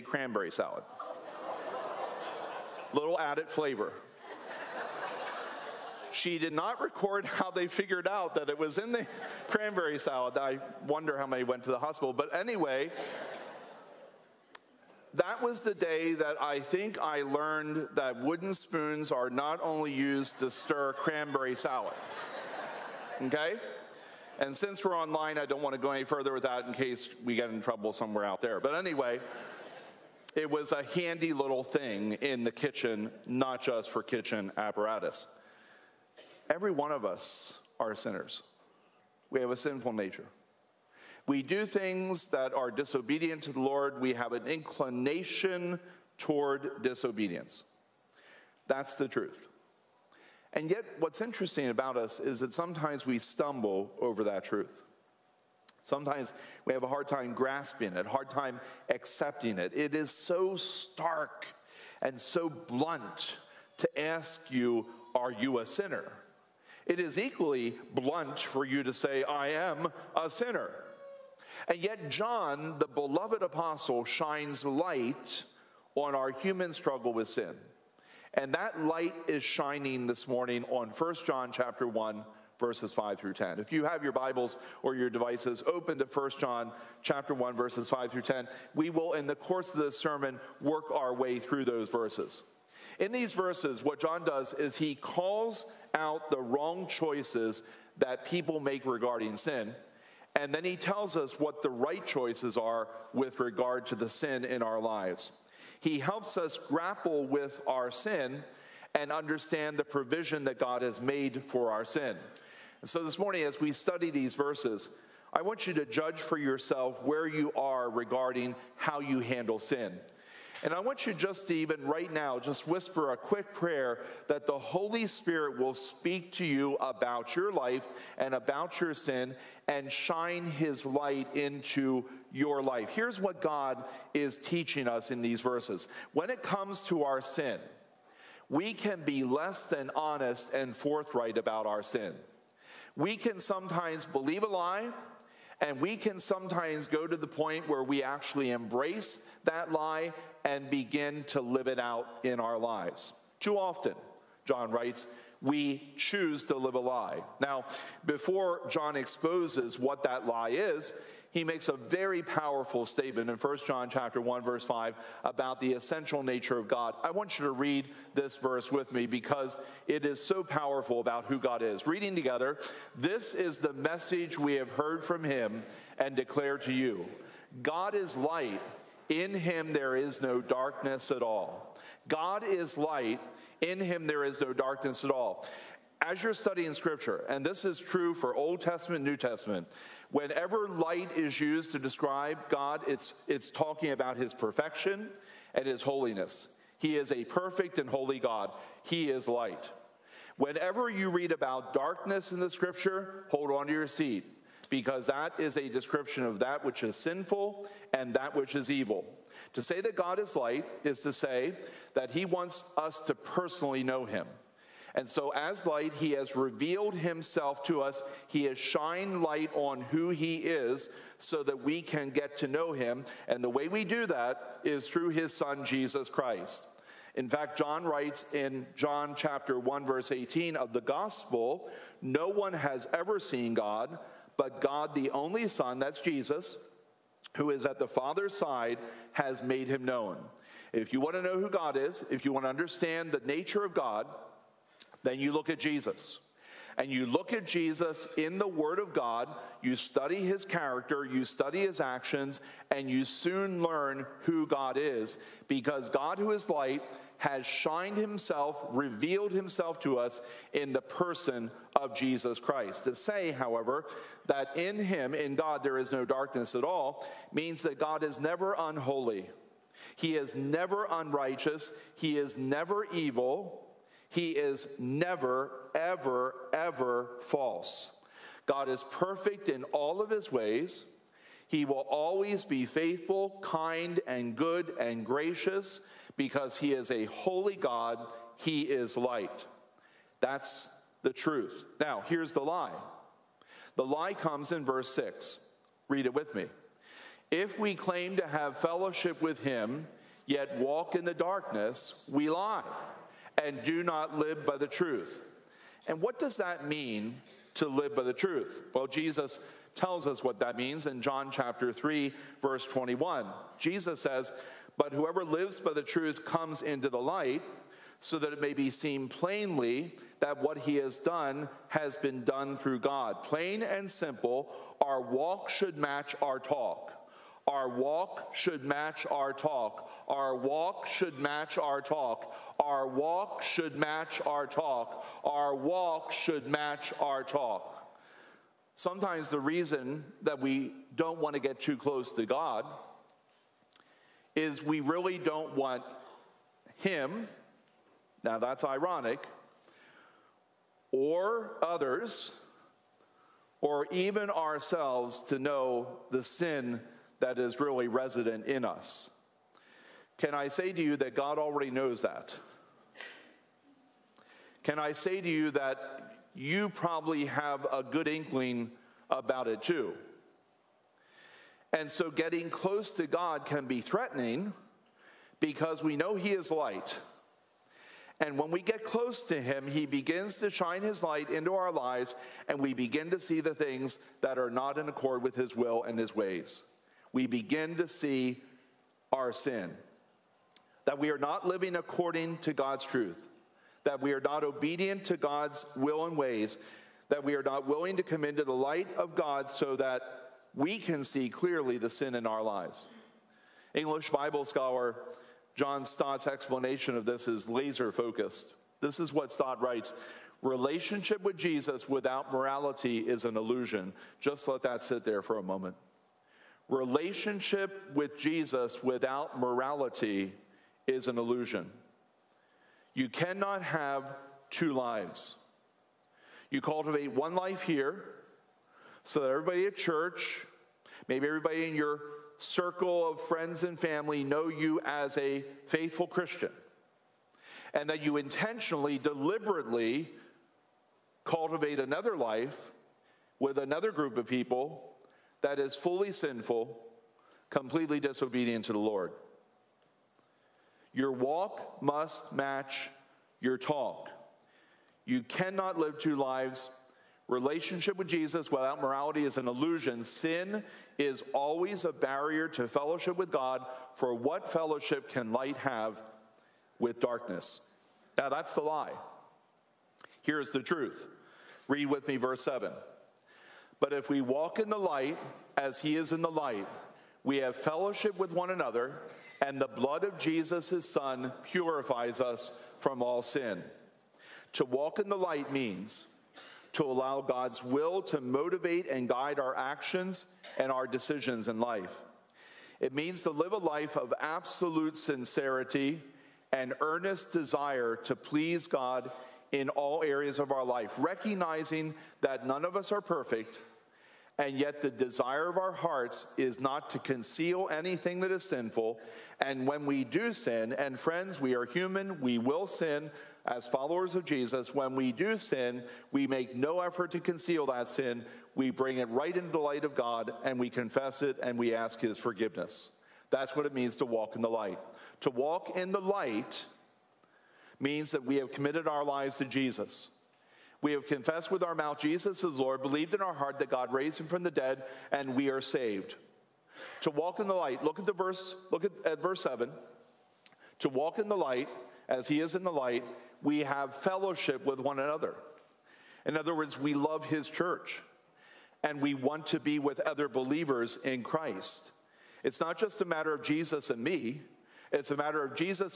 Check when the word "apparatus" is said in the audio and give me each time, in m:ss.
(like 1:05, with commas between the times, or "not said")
0:34.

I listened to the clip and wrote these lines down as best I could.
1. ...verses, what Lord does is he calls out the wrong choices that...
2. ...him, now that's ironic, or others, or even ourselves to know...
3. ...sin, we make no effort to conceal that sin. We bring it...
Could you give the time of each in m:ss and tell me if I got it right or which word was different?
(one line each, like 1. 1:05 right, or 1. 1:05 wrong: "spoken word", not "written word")
1. 1:33 wrong: "John", not "Lord"
2. 5:46 right
3. 8:35 right.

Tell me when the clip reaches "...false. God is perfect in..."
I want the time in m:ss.
4:37.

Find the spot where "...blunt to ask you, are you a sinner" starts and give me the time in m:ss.
1:02.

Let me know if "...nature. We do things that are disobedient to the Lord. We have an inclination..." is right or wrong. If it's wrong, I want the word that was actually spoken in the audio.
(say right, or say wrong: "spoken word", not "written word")
right.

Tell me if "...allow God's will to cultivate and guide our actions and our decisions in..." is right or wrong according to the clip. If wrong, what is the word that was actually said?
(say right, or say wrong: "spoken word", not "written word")
wrong: "motivate", not "cultivate".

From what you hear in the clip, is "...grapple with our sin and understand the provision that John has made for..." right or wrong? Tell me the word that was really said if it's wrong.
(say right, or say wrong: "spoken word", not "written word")
wrong: "God", not "John".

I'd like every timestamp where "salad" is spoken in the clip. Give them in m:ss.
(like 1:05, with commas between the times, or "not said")
0:00, 0:09, 0:21.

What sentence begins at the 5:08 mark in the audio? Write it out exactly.
Well, Jesus tells us what that means in John chapter 3, verse 21.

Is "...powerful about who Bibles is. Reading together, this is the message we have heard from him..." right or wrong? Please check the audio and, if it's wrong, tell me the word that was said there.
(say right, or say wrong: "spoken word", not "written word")
wrong: "God", not "Bibles".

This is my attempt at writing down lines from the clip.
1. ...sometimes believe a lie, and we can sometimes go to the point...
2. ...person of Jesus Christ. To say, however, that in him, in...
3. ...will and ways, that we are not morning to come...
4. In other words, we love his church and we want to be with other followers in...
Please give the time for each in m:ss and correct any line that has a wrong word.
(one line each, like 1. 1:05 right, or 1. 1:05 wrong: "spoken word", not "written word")
1. 2:23 right
2. 4:20 right
3. 6:35 wrong: "willing", not "morning"
4. 9:06 wrong: "believers", not "followers".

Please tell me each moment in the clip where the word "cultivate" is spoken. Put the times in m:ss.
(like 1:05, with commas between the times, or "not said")
7:06, 7:21.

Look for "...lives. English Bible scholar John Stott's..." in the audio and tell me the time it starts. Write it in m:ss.
6:42.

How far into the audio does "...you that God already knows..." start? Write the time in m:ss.
6:00.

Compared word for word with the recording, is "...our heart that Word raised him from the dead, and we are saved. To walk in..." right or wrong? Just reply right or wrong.
wrong.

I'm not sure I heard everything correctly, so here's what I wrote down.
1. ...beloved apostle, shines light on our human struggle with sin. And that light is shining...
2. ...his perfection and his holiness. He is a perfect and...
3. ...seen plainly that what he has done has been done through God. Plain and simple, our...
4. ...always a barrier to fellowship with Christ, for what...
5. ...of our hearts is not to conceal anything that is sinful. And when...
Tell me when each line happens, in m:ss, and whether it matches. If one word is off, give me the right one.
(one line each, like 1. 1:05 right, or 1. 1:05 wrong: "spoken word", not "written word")
1. 1:12 right
2. 3:14 right
3. 5:18 right
4. 7:41 wrong: "God", not "Christ"
5. 8:25 right.